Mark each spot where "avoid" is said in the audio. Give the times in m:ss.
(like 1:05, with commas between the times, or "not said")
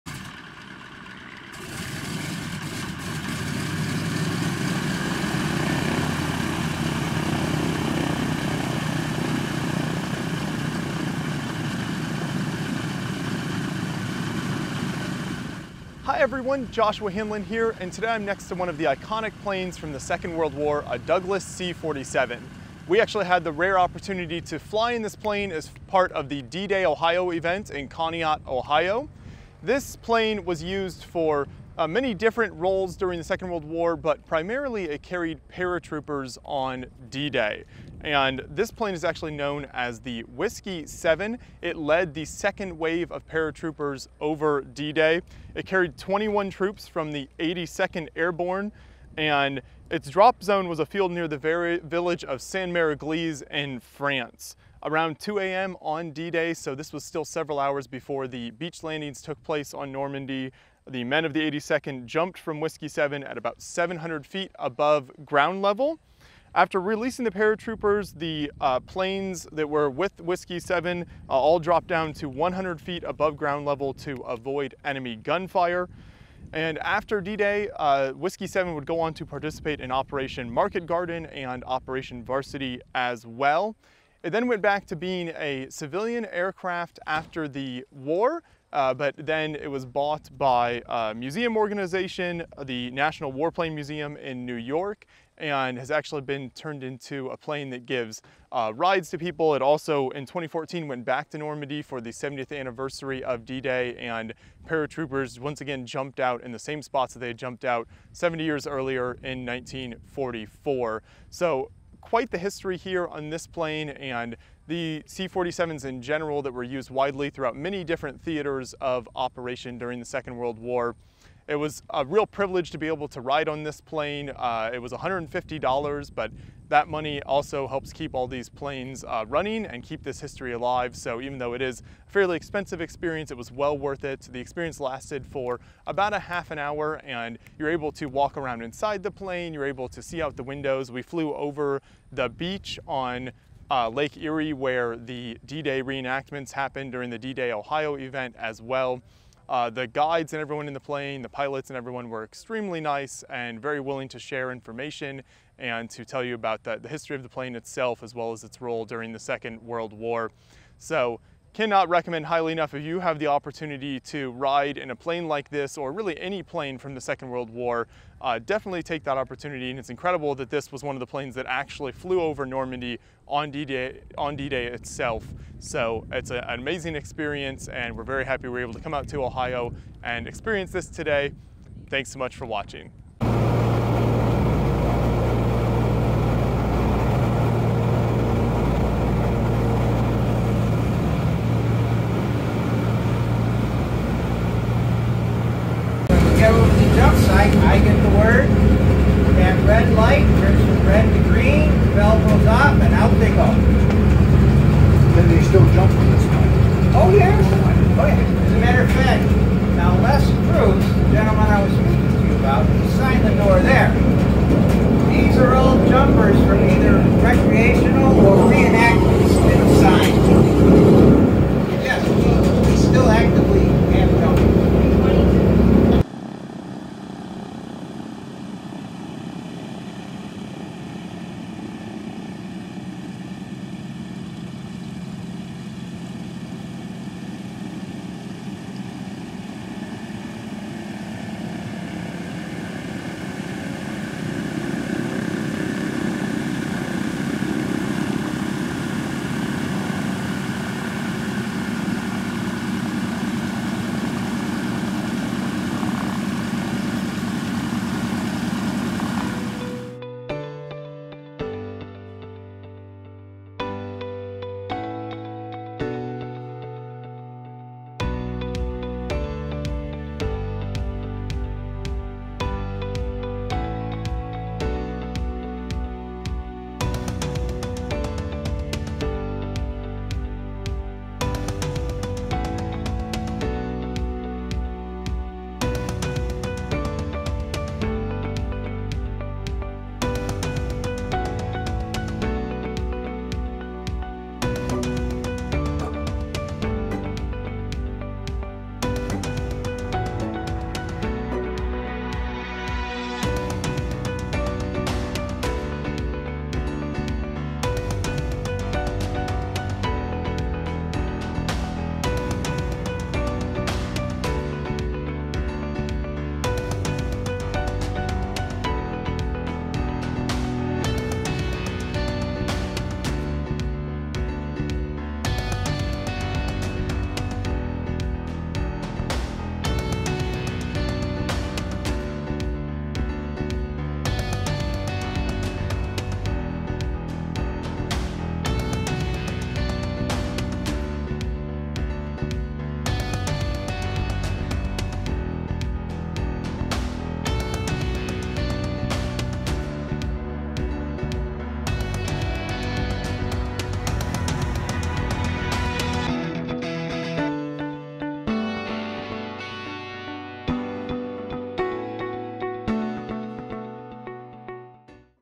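1:14.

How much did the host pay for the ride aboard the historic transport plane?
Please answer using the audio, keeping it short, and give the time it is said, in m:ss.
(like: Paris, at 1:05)
$150, at 2:04.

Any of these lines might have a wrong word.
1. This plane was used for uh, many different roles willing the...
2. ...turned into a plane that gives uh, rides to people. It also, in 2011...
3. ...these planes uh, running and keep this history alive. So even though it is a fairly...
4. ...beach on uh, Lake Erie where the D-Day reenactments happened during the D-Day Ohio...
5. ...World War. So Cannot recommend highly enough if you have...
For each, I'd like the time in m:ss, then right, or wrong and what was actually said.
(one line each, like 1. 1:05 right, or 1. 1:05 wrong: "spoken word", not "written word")
1. 0:29 wrong: "during", not "willing"
2. 1:36 wrong: "2014", not "2011"
3. 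2:08 right
4. 2:22 right
5. 2:39 right.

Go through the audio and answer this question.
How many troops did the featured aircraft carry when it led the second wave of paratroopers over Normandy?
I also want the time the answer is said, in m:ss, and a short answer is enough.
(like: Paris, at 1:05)
21, at 0:45.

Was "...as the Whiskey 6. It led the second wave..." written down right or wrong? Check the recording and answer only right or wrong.
wrong.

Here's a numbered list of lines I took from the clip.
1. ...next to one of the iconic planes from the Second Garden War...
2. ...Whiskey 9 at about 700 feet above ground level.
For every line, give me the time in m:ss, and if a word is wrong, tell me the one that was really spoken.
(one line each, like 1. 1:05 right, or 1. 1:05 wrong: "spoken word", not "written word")
1. 0:18 wrong: "World", not "Garden"
2. 1:02 wrong: "7", not "9".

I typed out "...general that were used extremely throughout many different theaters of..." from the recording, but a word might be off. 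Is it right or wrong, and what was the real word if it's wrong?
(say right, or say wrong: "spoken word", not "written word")
wrong: "widely", not "extremely".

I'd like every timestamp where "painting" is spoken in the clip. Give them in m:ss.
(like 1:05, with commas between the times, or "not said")
not said.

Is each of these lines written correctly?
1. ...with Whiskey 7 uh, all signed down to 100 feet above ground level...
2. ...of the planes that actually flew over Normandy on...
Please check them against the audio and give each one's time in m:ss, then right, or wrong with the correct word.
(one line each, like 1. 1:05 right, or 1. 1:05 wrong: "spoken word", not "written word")
1. 1:09 wrong: "dropped", not "signed"
2. 2:50 right.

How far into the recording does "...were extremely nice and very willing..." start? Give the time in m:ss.
2:32.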